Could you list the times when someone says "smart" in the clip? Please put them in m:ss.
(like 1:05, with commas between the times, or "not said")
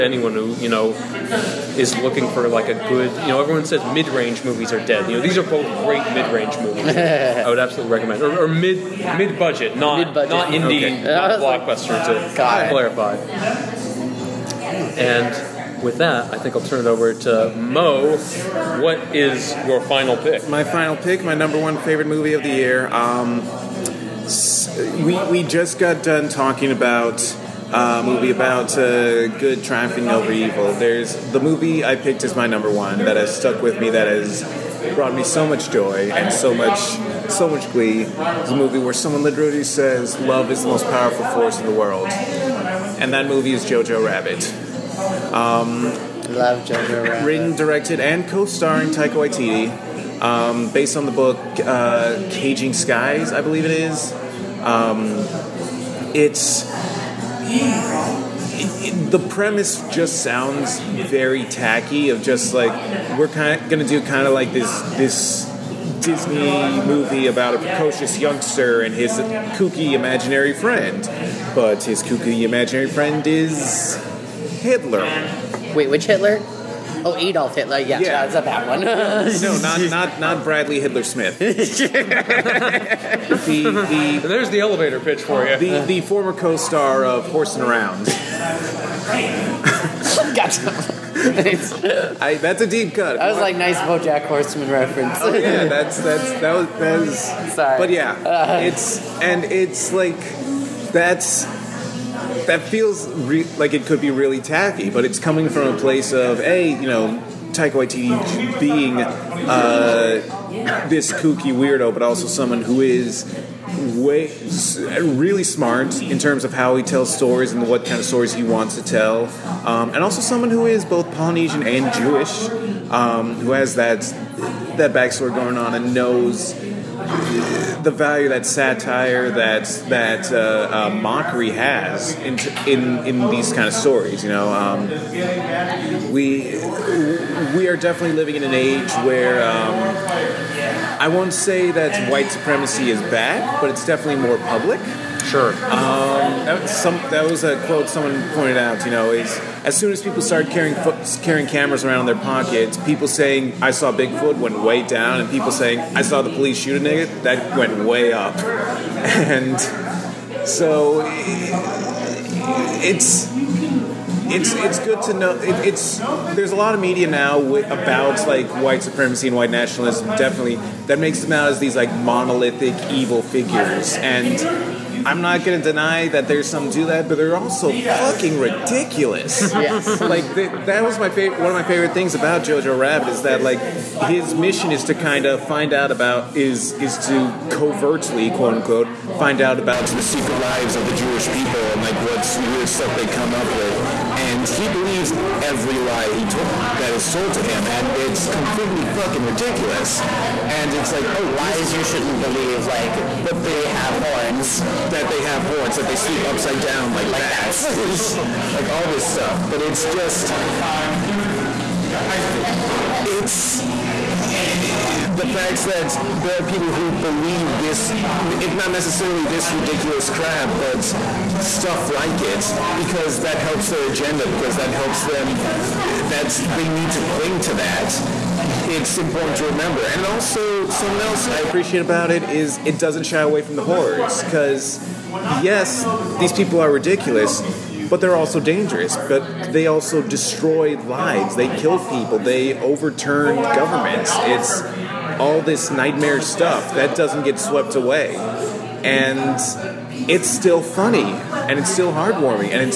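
1:55.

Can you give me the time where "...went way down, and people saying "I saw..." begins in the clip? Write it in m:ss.
2:34.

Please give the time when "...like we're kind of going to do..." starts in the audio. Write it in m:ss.
1:02.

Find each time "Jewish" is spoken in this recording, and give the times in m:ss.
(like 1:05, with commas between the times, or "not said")
2:01, 3:10.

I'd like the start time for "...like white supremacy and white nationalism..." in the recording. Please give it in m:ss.
2:48.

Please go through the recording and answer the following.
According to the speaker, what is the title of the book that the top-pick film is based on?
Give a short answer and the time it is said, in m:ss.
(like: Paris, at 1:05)
Caging Skies, at 0:52.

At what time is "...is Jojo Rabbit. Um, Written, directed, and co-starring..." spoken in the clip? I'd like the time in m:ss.
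0:43.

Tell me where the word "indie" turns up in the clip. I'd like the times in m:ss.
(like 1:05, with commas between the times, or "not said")
0:10.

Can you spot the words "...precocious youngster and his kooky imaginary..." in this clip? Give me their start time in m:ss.
1:07.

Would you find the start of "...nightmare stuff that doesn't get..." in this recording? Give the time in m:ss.
4:05.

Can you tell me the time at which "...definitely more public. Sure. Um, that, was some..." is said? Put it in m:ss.
2:23.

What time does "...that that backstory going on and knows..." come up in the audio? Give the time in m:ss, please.
2:03.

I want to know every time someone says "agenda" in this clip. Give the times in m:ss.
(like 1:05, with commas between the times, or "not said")
3:43.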